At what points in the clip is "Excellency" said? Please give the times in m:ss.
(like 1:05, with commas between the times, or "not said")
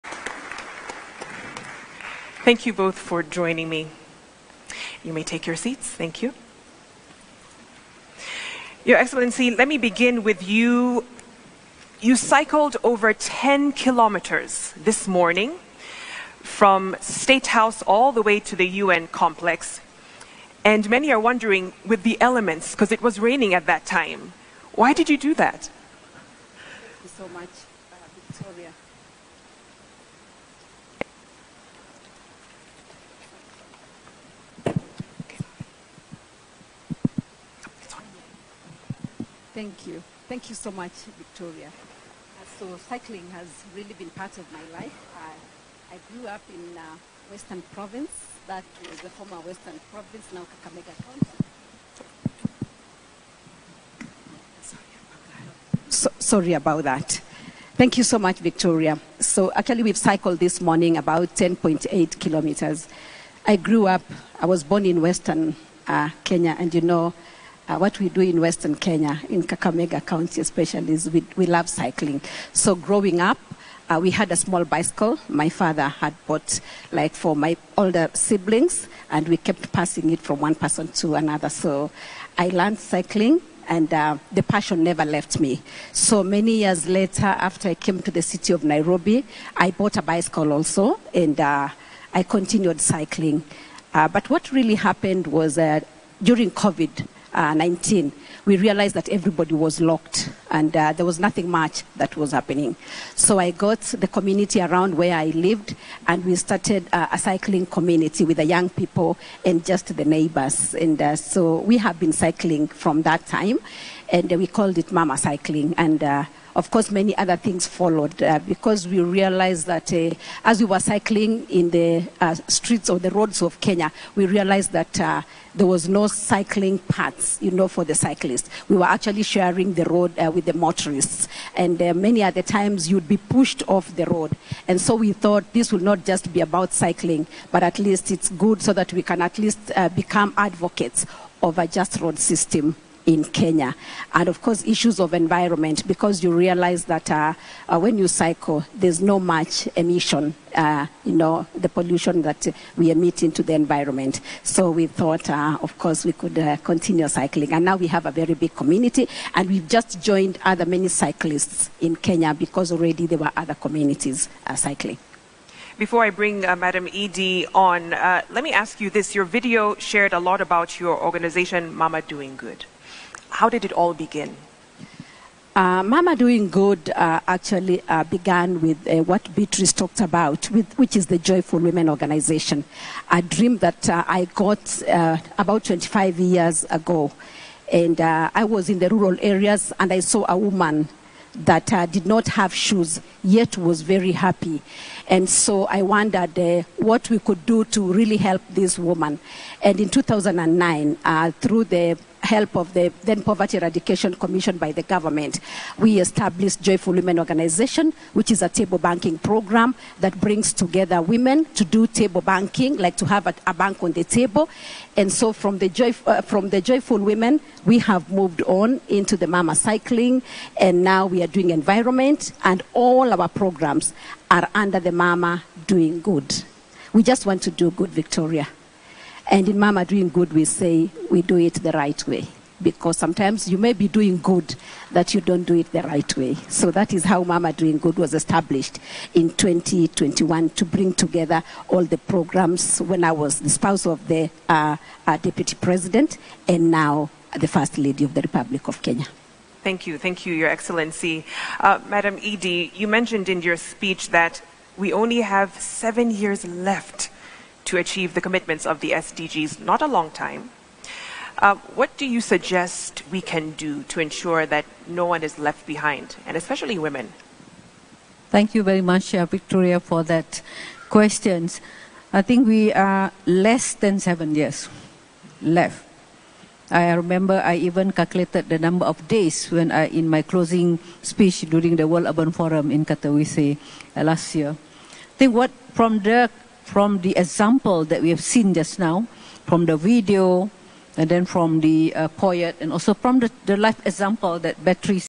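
0:08, 4:10.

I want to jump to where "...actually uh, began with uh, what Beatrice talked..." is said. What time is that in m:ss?
2:57.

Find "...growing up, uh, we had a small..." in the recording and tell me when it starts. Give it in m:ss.
1:12.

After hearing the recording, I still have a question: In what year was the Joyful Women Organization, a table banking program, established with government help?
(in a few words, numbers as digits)
2009.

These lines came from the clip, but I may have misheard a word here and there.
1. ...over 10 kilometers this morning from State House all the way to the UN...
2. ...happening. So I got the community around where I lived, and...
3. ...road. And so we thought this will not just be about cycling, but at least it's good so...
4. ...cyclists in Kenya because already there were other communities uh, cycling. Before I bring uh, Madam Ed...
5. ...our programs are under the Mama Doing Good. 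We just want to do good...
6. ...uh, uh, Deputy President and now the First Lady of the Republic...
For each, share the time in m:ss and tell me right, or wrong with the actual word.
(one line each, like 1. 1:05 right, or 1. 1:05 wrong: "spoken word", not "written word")
1. 0:12 right
2. 1:42 right
3. 2:14 right
4. 2:40 right
5. 3:43 right
6. 4:04 right.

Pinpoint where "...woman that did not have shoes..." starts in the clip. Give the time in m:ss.
3:10.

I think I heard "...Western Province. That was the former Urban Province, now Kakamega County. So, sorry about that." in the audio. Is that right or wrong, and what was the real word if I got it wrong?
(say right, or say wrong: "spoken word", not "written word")
wrong: "Western", not "Urban".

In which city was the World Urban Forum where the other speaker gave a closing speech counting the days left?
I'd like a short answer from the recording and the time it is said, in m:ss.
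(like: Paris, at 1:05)
Katowice, at 4:42.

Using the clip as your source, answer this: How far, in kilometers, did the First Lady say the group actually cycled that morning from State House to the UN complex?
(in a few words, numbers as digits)
10.8 kilometers.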